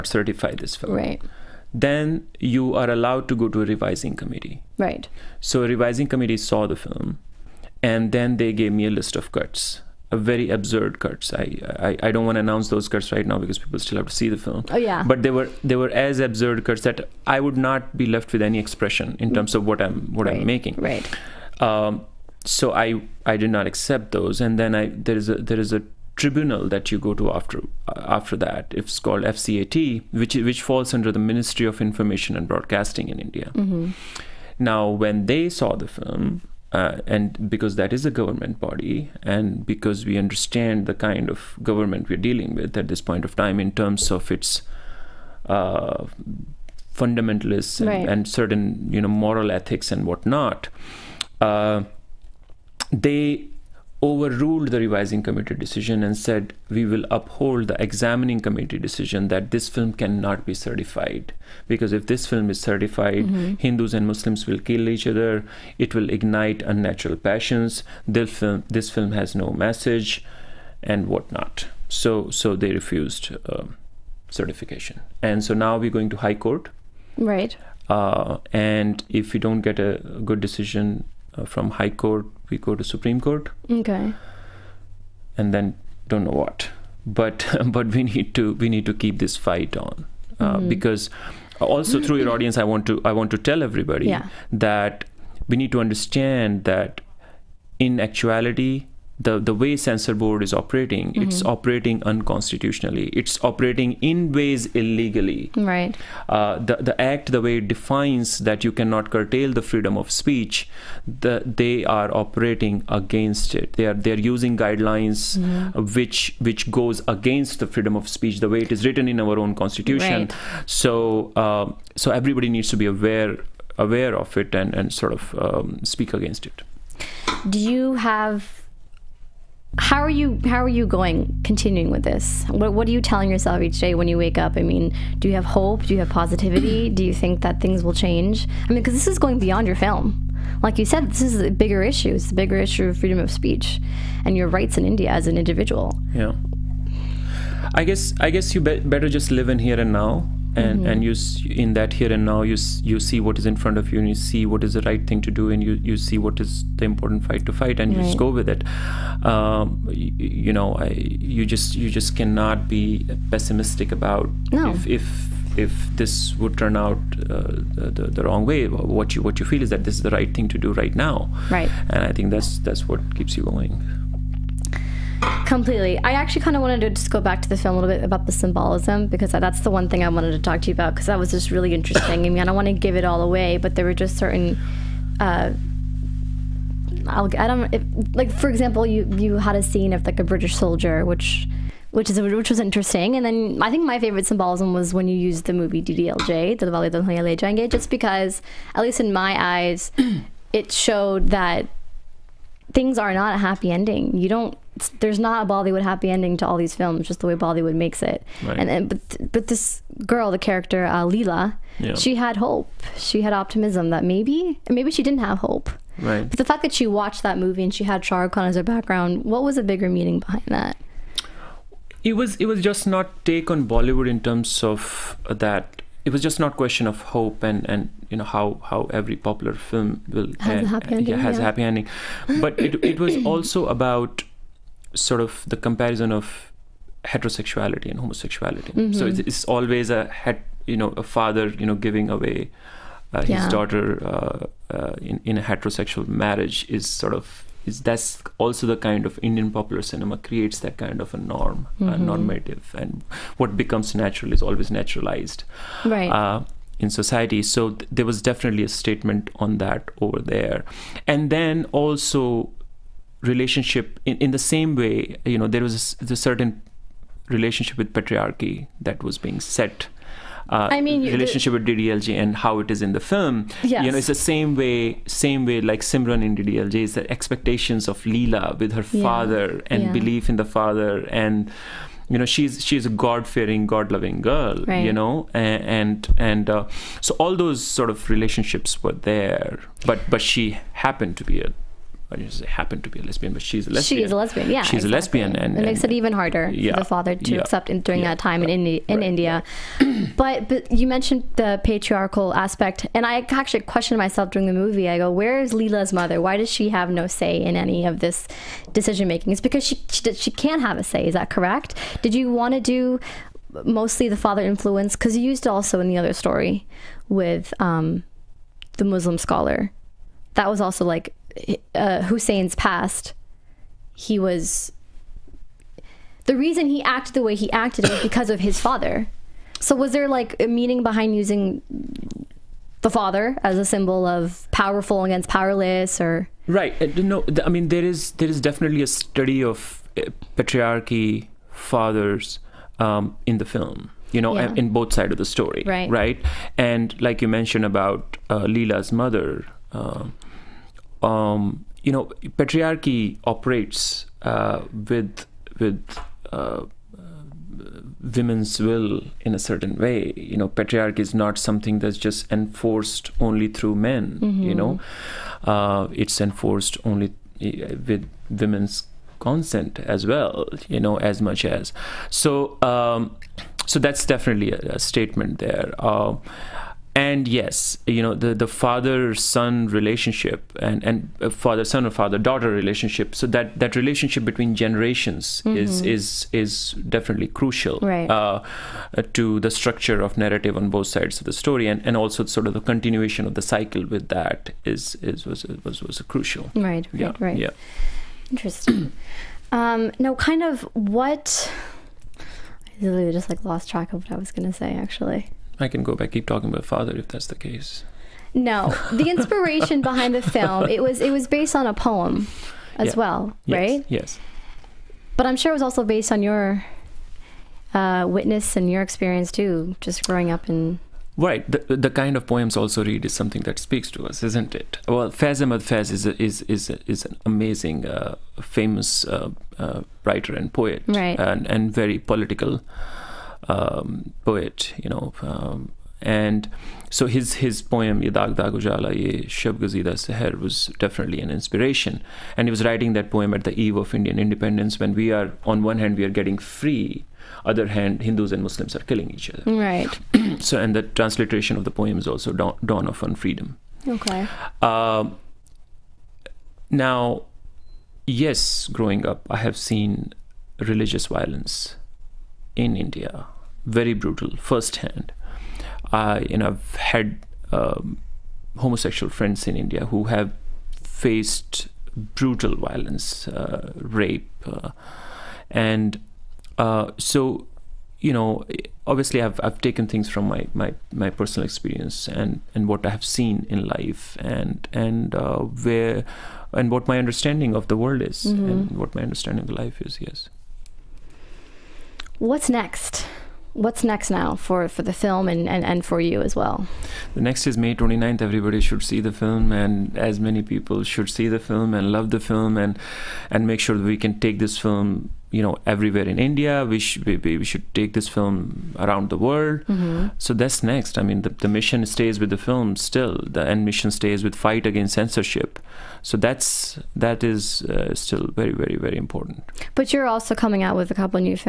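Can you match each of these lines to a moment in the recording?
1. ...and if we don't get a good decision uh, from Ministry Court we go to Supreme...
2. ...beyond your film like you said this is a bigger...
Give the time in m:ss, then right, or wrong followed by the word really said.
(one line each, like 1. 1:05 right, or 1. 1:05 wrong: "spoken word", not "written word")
1. 1:18 wrong: "High", not "Ministry"
2. 2:19 right.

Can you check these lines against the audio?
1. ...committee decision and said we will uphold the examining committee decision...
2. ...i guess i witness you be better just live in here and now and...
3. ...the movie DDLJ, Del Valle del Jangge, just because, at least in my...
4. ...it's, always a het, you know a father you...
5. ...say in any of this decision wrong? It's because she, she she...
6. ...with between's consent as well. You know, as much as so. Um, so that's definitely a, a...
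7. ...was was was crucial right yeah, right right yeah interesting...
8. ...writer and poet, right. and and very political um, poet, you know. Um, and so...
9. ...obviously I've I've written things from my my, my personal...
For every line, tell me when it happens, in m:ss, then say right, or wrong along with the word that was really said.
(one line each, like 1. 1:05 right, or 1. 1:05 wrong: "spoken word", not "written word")
1. 0:55 right
2. 2:27 wrong: "guess", not "witness"
3. 3:15 right
4. 3:59 right
5. 5:07 wrong: "making", not "wrong"
6. 6:07 wrong: "women", not "between"
7. 6:35 right
8. 7:10 right
9. 7:58 wrong: "taken", not "written".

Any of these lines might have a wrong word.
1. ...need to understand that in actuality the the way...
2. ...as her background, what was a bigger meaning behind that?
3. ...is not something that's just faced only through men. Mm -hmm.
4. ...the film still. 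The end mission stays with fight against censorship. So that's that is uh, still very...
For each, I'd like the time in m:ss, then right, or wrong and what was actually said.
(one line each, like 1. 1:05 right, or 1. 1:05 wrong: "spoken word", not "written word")
1. 1:35 right
2. 3:38 right
3. 6:00 wrong: "enforced", not "faced"
4. 8:32 right.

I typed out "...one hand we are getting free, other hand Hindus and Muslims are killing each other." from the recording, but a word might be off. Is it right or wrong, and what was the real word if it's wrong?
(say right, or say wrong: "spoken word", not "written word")
right.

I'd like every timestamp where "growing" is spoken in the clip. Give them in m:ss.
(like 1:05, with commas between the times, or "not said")
7:00, 7:38.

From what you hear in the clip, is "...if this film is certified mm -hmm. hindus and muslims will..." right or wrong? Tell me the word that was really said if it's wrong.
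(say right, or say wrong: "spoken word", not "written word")
right.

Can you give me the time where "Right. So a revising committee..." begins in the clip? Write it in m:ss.
0:04.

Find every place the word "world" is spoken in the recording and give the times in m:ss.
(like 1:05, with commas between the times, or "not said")
8:07, 8:29.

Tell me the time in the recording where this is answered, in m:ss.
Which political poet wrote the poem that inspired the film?
7:05.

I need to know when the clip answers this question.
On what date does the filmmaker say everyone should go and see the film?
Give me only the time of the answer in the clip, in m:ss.
8:17.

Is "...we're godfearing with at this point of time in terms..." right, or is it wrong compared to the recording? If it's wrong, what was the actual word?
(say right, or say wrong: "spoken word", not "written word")
wrong: "dealing", not "godfearing".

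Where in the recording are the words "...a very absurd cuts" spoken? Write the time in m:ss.
0:10.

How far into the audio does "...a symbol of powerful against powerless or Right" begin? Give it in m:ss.
5:33.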